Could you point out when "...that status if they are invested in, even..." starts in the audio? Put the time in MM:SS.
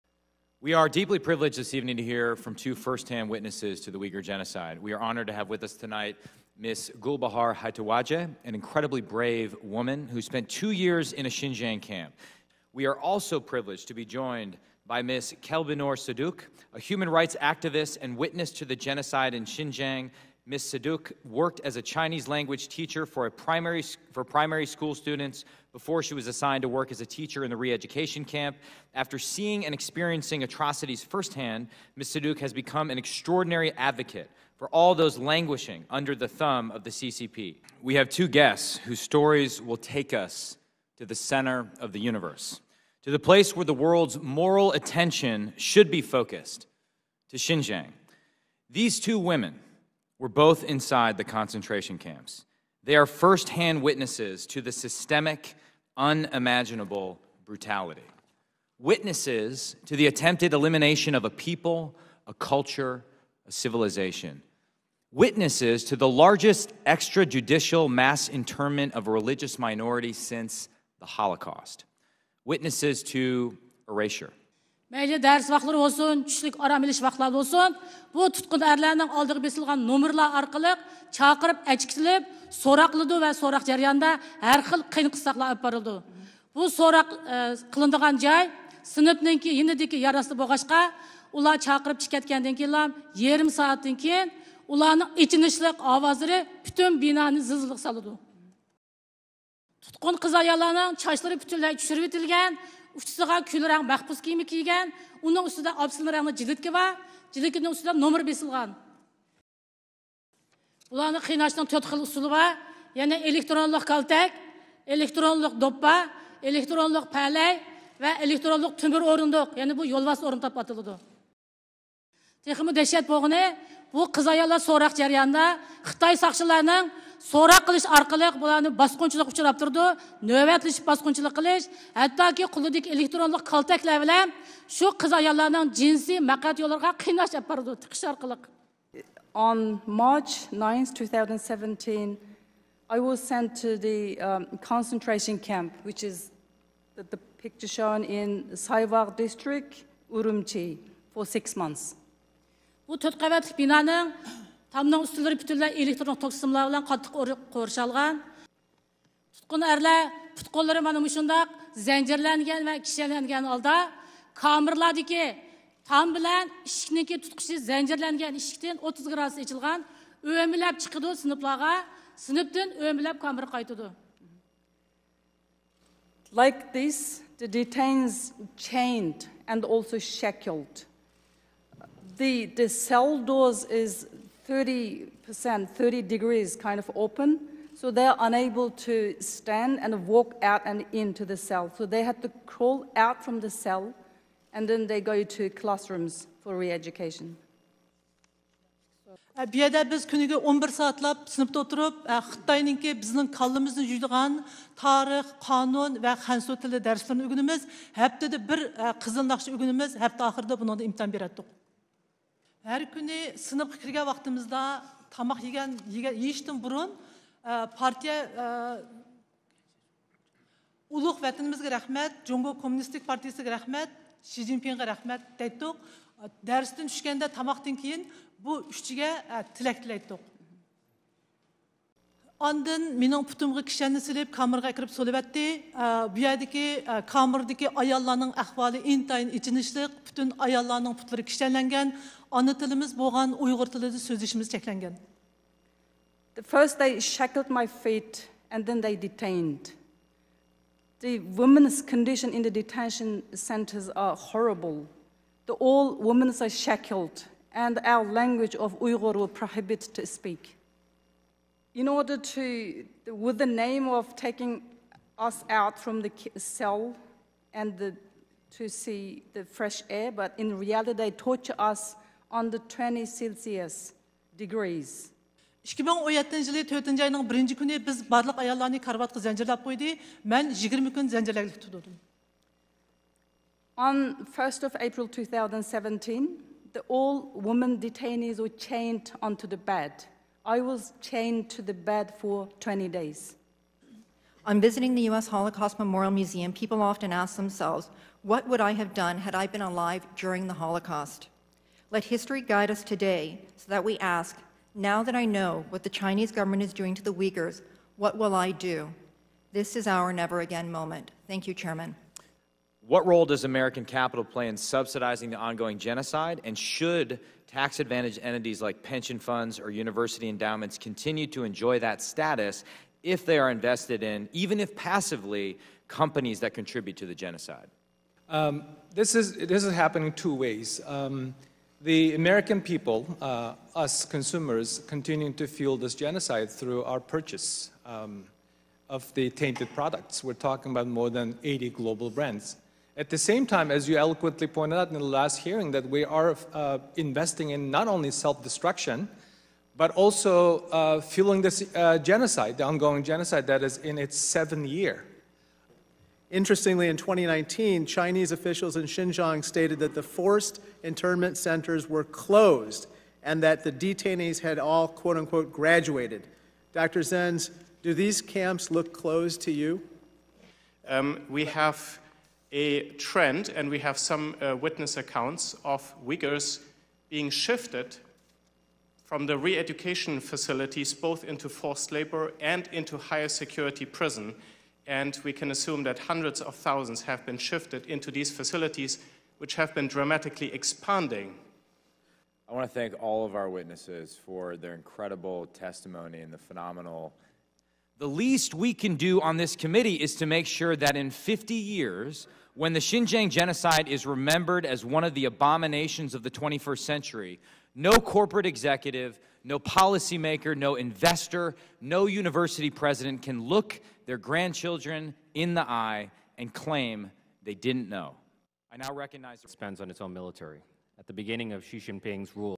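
05:21.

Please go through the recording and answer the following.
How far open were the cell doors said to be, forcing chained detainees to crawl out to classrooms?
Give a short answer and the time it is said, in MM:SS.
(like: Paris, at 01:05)
30 degrees, at 03:05.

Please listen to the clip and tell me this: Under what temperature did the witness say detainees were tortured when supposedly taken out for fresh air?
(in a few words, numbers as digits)
20 Celsius.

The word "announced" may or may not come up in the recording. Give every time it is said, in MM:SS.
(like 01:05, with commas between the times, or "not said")
not said.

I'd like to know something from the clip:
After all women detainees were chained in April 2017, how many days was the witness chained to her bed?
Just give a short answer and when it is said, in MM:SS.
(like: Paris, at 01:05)
20 days, at 04:52.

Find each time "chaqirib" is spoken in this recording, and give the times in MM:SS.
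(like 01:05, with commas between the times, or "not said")
01:21, 01:31.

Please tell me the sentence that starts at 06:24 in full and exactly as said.
And we can assume that hundreds of thousands have been shifted into these facilities, which have been dramatically expanding.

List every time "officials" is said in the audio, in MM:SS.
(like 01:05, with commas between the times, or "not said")
05:58.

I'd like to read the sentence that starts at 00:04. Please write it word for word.
We are honored to have with us tonight Ms.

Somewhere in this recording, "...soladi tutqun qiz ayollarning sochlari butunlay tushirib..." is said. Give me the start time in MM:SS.
01:37.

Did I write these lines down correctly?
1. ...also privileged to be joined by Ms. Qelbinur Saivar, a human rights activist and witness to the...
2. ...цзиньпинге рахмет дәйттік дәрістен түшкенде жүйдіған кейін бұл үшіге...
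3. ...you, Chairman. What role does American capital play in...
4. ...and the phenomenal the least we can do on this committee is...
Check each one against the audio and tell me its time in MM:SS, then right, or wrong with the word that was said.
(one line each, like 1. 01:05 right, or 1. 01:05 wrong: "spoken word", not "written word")
1. 00:12 wrong: "Saduk", not "Saivar"
2. 03:44 wrong: "тамақтан", not "жүйдіған"
3. 05:11 right
4. 06:36 right.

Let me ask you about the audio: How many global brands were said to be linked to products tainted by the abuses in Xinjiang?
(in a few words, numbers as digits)
more than 80.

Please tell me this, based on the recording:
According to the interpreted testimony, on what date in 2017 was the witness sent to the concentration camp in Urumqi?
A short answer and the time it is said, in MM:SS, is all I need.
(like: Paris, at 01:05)
March 9 2017, at 02:02.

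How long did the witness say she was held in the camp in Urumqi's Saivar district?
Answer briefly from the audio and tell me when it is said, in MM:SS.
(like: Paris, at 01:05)
six months, at 02:31.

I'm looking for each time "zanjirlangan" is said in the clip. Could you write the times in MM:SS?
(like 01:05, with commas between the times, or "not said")
02:41, 02:47.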